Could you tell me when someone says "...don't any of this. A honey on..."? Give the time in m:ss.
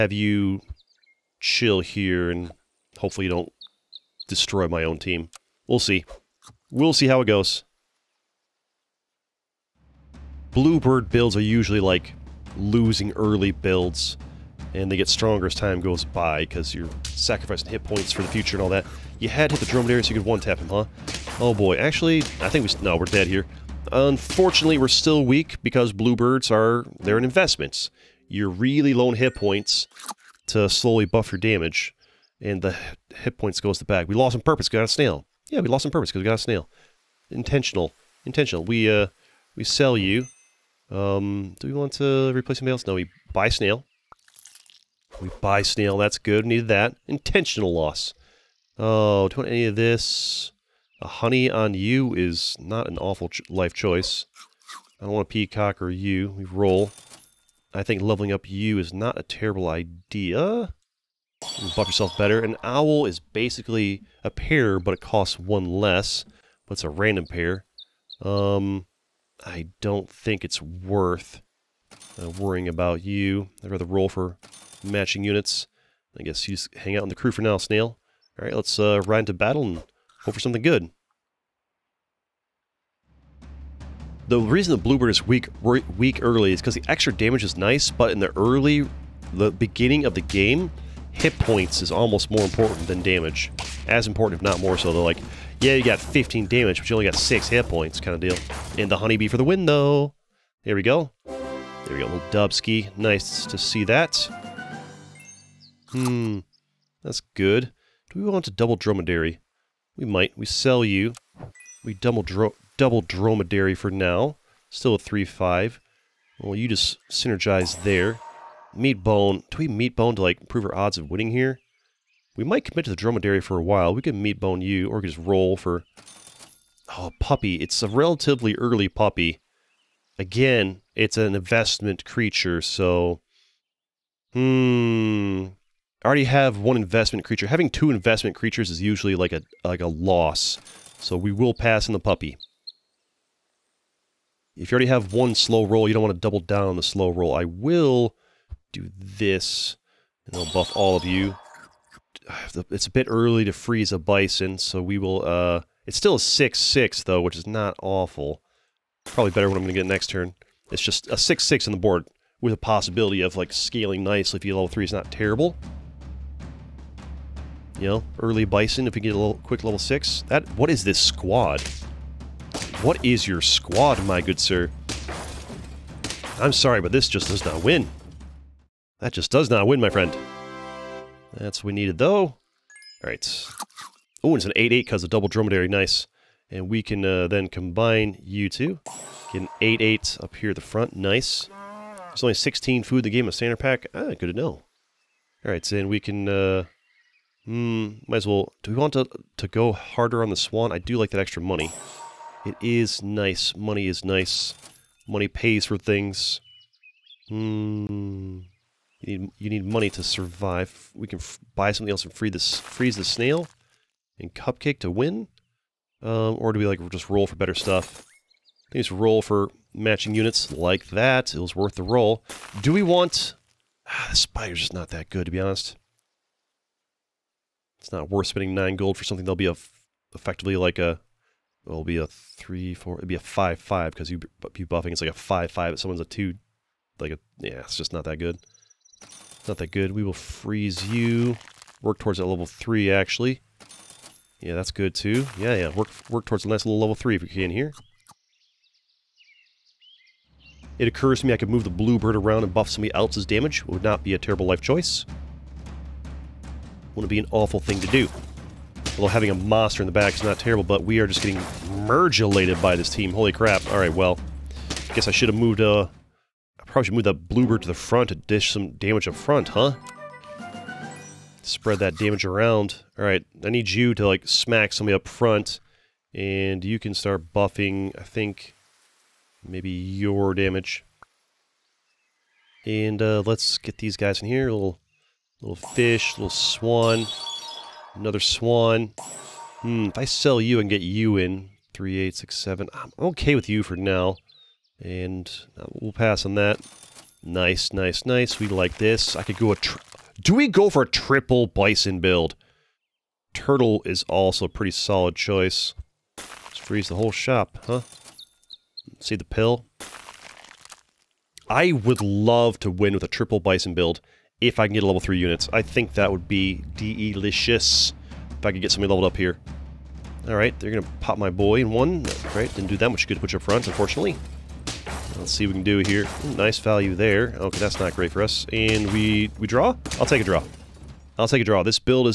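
0:49.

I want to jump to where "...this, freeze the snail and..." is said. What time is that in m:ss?
3:32.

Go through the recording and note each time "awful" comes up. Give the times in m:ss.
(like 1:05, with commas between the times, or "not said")
0:52, 2:37, 4:17.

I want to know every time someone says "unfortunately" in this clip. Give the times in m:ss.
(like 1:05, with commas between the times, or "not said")
0:23, 5:23.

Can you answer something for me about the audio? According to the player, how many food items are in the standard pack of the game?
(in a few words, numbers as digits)
16.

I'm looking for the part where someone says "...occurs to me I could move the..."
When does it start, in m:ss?
4:10.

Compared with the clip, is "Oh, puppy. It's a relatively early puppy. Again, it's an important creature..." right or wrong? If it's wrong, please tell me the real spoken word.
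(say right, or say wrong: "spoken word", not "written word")
wrong: "investment", not "important".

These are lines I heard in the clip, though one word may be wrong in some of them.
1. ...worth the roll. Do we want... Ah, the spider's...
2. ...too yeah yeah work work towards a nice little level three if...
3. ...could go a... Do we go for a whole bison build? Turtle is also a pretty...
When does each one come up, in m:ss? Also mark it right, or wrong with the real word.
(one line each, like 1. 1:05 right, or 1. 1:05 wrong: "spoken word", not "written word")
1. 3:41 right
2. 4:04 right
3. 4:59 wrong: "triple", not "whole".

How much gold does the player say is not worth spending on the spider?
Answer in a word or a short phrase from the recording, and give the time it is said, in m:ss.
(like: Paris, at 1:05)
9, at 3:48.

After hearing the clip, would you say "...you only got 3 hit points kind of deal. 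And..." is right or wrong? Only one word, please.
wrong.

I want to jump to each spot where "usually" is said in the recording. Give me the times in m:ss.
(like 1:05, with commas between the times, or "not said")
0:11, 2:18.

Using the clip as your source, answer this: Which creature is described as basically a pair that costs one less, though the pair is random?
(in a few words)
Owl.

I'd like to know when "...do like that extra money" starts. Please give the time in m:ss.
3:20.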